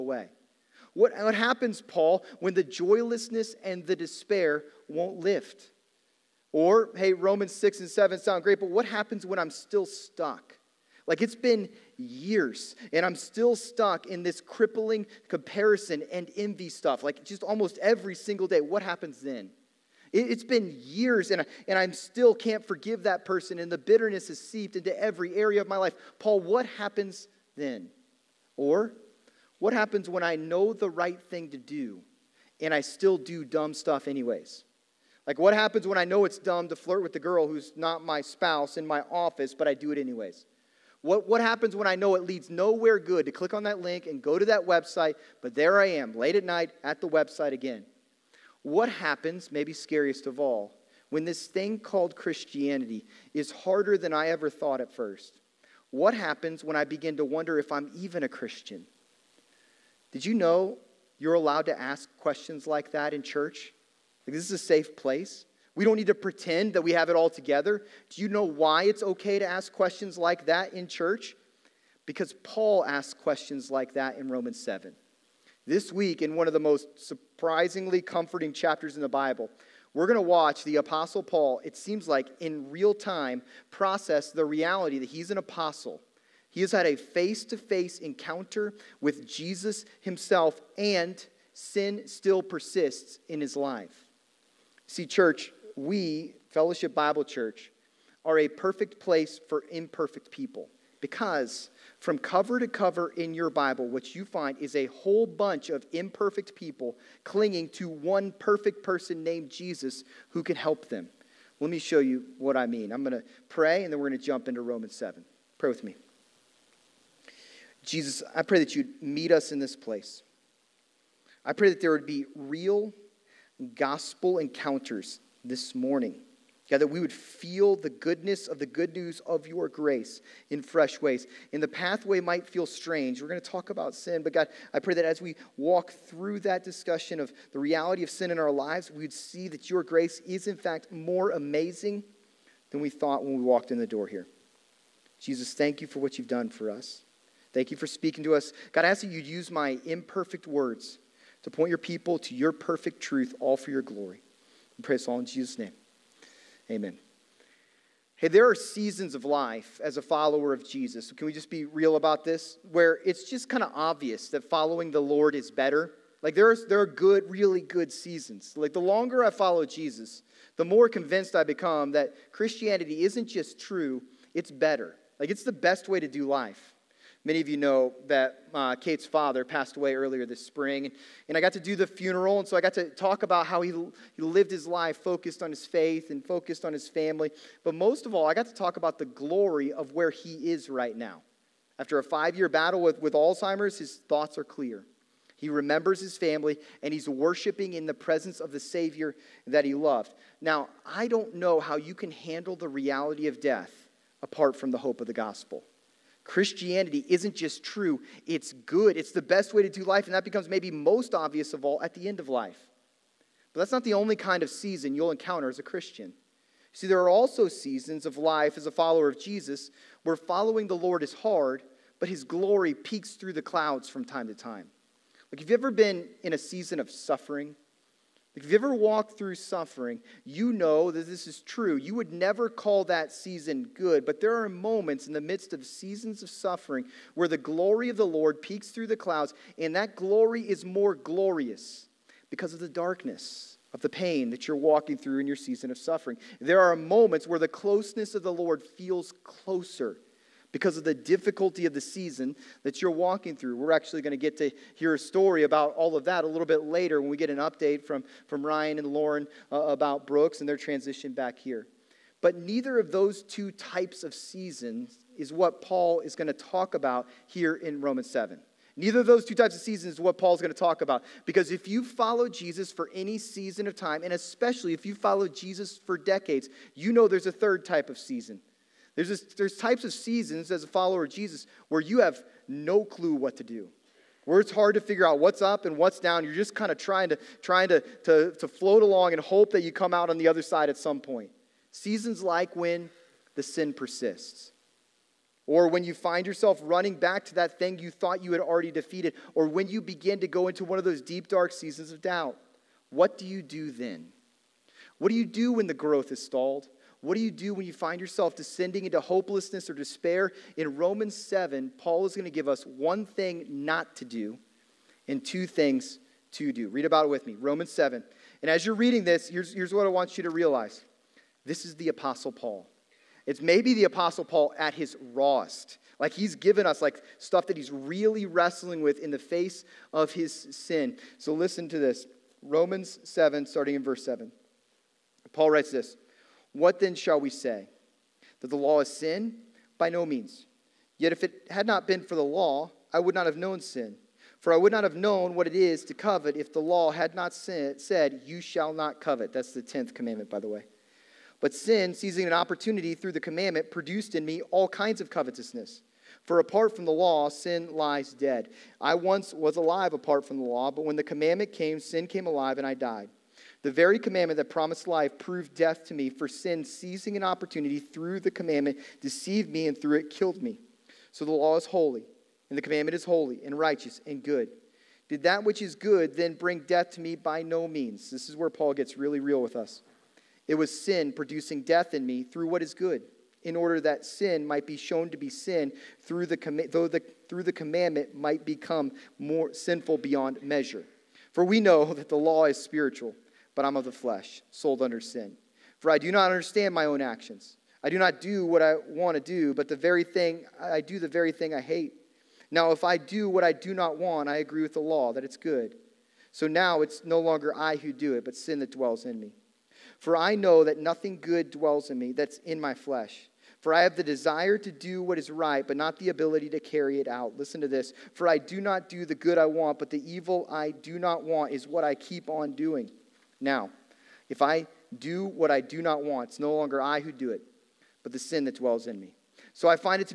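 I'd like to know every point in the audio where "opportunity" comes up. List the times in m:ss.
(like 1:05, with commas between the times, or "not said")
5:52, 6:07.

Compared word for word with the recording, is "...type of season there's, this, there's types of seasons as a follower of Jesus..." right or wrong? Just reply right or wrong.
right.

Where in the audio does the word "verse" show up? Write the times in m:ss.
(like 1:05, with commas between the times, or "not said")
5:33.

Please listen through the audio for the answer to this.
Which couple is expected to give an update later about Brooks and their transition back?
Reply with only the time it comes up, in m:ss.
4:18.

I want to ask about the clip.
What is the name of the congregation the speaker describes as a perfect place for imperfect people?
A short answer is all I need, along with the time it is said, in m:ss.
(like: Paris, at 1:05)
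Fellowship Bible Church, at 1:36.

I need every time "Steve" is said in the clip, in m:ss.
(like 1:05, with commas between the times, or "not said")
not said.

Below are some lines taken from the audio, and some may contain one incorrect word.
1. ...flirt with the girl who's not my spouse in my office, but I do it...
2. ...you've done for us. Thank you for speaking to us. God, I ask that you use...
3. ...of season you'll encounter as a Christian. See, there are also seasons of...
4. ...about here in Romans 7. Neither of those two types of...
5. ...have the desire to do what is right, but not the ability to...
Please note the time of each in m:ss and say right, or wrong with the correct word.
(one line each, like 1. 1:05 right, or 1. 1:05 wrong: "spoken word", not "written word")
1. 0:36 right
2. 2:26 right
3. 3:34 right
4. 4:26 right
5. 6:53 right.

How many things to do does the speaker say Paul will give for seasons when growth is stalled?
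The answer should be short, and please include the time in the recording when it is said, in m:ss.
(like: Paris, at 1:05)
2, at 5:15.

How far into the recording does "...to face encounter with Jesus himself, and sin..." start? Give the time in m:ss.
1:27.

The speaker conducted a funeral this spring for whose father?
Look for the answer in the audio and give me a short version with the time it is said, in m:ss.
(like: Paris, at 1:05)
Kate, at 2:58.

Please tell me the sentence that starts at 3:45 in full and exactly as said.
Like, have you ever been in a season of suffering?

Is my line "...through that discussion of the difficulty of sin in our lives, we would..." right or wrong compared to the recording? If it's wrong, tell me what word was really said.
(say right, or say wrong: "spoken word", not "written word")
wrong: "reality", not "difficulty".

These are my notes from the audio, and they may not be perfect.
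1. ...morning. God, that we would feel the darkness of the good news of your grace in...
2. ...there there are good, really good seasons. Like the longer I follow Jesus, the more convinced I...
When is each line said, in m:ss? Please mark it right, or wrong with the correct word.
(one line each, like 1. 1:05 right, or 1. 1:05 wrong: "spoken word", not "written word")
1. 2:05 wrong: "goodness", not "darkness"
2. 2:46 right.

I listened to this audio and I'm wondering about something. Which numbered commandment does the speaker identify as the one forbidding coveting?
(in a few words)
10th.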